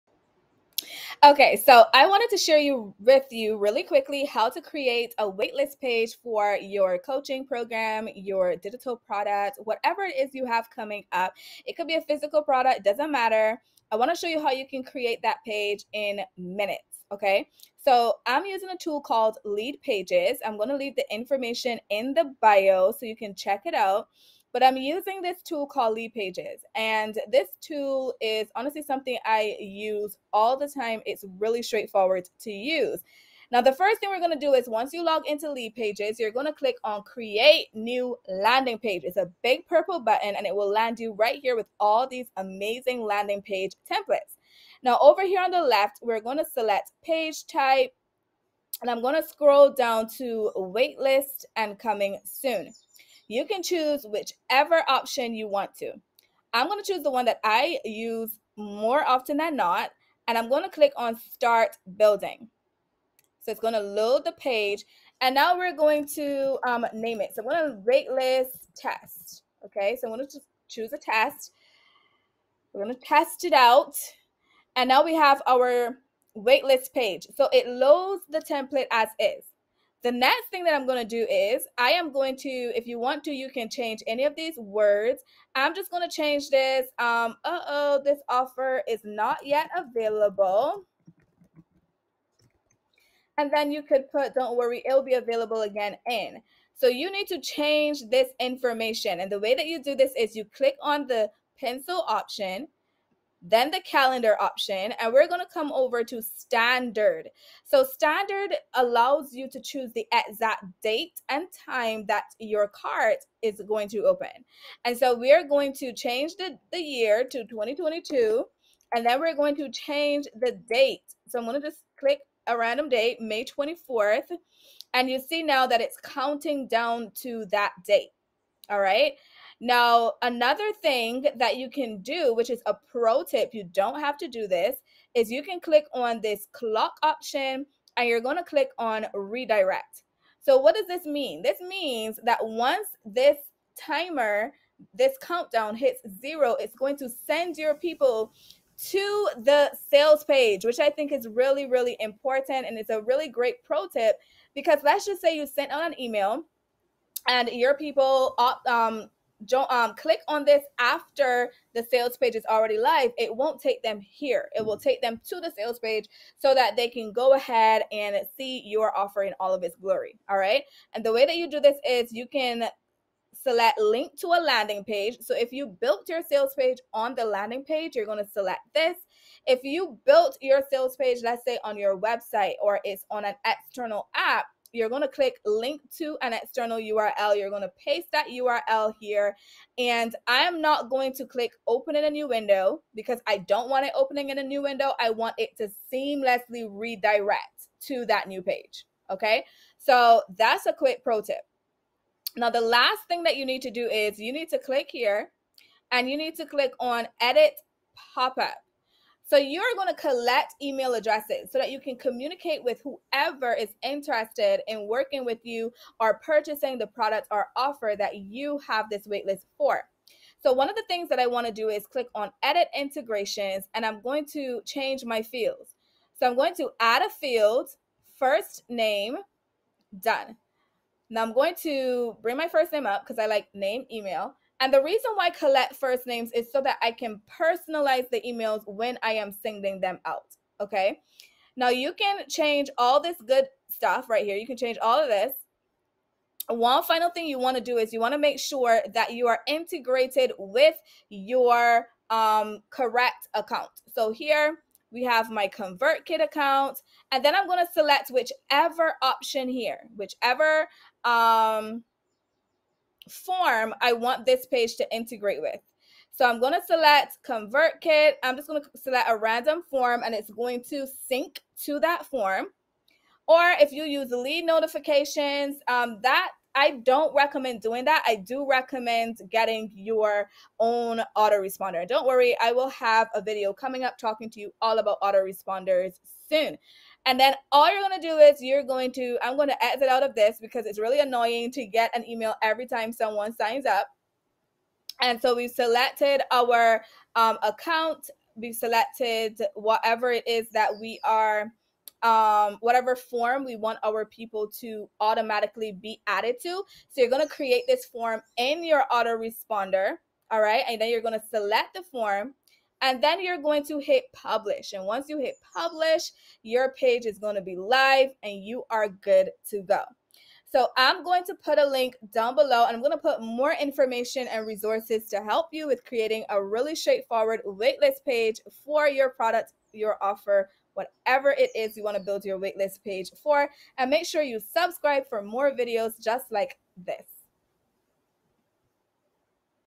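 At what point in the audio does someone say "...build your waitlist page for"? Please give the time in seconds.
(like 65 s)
332 s.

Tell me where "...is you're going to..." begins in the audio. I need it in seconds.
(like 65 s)
288 s.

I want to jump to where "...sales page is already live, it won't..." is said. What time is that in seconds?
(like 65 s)
161 s.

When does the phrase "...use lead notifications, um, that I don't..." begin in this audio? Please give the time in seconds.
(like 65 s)
273 s.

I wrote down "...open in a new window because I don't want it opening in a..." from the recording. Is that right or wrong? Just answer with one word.
right.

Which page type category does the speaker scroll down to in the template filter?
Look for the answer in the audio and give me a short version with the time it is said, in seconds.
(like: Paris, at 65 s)
waitlist and coming soon, at 50 s.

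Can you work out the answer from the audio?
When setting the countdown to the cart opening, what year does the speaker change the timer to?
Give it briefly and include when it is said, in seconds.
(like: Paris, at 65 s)
2022, at 117 s.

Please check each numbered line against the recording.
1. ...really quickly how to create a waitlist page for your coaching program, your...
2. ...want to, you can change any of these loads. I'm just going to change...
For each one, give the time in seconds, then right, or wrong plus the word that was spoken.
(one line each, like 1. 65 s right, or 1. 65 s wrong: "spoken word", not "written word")
1. 3 s right
2. 82 s wrong: "words", not "loads".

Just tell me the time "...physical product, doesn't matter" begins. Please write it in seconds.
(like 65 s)
12 s.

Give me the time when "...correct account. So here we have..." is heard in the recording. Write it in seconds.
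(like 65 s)
252 s.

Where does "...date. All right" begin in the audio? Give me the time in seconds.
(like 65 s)
127 s.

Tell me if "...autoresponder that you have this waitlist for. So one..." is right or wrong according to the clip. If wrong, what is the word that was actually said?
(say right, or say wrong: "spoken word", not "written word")
wrong: "offer", not "autoresponder".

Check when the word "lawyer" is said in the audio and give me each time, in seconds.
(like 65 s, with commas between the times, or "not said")
not said.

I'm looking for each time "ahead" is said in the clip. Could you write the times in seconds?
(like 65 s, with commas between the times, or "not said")
167 s.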